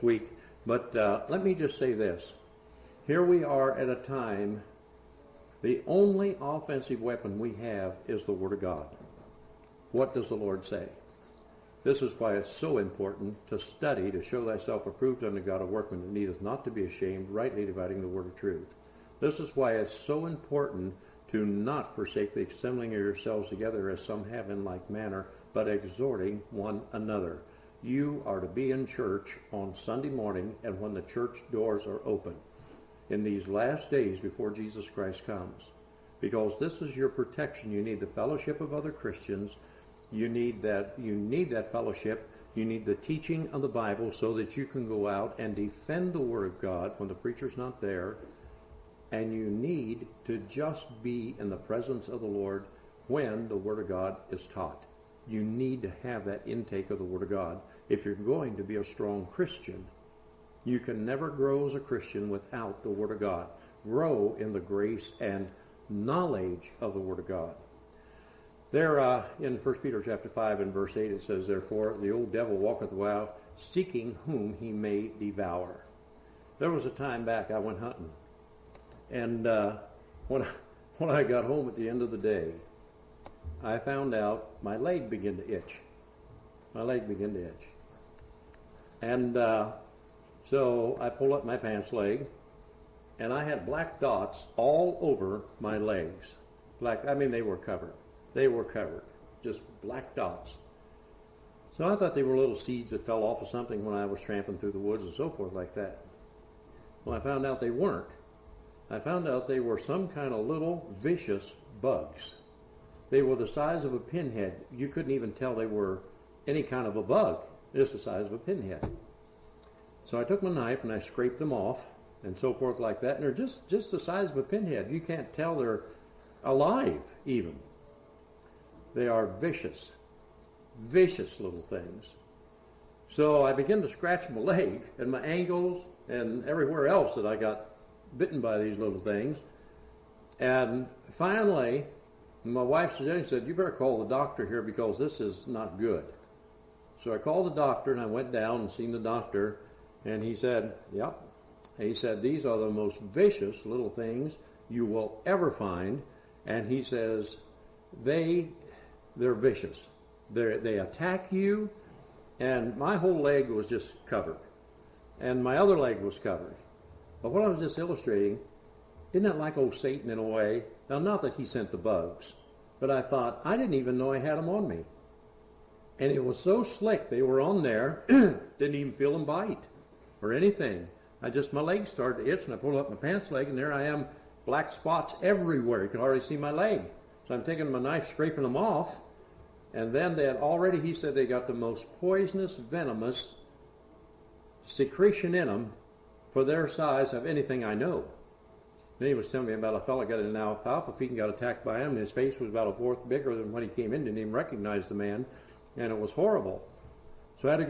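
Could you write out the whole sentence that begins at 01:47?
Well, I found out they weren't.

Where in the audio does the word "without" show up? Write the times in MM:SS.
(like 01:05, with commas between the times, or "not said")
01:02.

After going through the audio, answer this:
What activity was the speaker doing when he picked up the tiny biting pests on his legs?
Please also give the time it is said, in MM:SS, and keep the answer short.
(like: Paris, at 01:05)
Hunting, at 01:17.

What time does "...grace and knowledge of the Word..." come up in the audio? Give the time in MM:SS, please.
01:04.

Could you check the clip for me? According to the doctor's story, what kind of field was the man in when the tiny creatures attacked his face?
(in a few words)
Alfalfa.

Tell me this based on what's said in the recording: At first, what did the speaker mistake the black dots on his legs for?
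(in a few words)
Little seeds.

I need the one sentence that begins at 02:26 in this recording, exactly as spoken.
So I called the doctor and I went down and seen the doctor.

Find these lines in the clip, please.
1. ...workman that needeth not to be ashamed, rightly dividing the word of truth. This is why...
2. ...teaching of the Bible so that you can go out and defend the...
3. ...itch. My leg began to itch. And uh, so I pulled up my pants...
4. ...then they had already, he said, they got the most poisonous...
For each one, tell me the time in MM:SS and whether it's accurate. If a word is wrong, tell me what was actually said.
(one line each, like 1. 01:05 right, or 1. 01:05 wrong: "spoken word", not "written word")
1. 00:15 right
2. 00:42 right
3. 01:25 right
4. 03:09 right.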